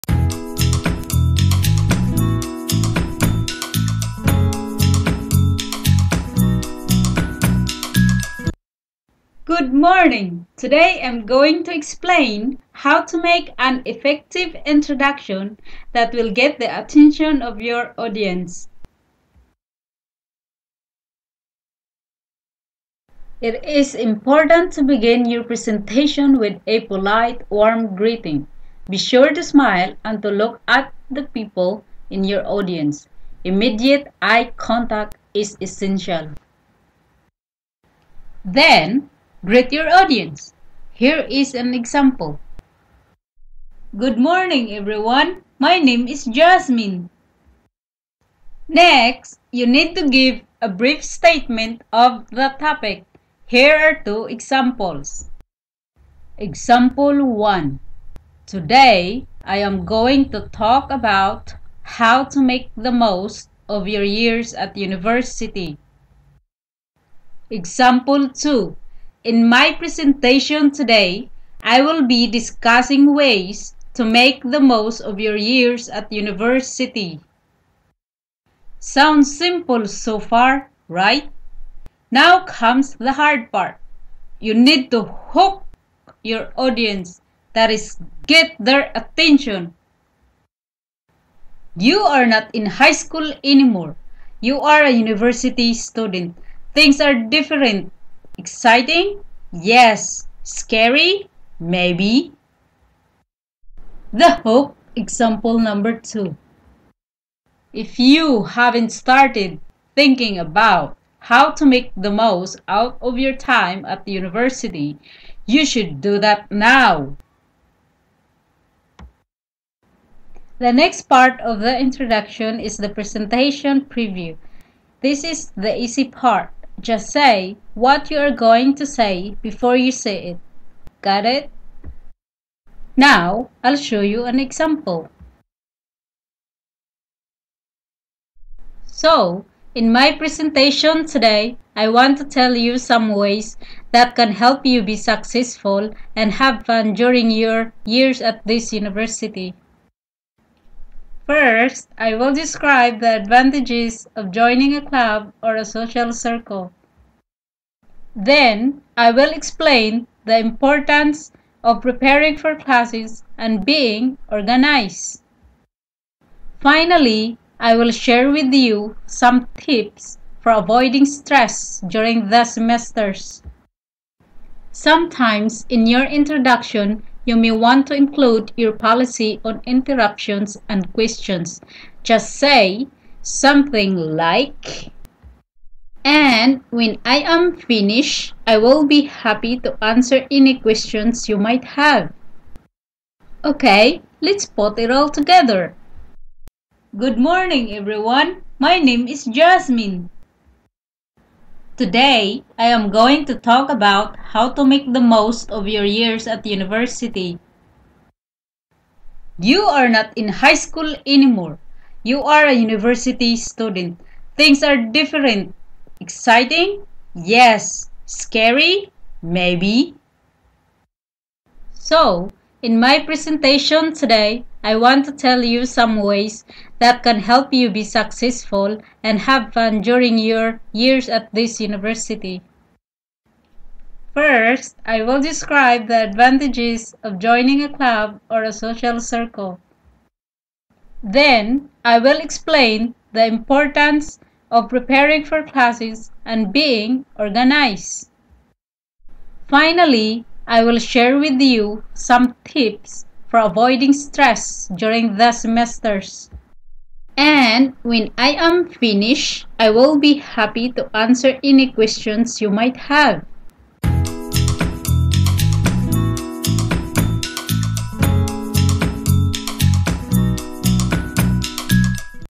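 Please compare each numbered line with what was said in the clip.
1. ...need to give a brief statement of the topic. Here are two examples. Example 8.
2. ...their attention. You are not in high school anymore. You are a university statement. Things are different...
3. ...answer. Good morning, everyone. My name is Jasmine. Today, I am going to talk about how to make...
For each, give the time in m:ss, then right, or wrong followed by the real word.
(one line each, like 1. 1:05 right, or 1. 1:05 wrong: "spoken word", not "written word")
1. 0:49 wrong: "1", not "8"
2. 1:28 wrong: "student", not "statement"
3. 3:15 wrong: "together", not "answer".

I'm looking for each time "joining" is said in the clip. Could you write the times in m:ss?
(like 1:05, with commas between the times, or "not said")
2:34, 3:57.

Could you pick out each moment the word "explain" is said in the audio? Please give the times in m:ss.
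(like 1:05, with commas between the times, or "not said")
0:11, 2:39, 4:02.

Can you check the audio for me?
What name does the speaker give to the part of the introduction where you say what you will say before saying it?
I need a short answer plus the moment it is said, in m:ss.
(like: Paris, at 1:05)
presentation preview, at 2:02.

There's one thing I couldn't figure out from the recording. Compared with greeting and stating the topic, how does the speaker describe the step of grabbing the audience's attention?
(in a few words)
the hard part.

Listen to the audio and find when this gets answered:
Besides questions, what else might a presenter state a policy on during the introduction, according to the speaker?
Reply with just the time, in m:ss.
2:59.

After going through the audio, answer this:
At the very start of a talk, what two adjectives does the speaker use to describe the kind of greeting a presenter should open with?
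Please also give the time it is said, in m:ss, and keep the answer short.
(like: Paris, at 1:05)
polite, warm, at 0:26.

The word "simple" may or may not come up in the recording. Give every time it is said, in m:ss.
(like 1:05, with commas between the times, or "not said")
1:19.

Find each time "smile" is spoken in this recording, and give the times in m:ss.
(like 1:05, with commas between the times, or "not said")
0:29.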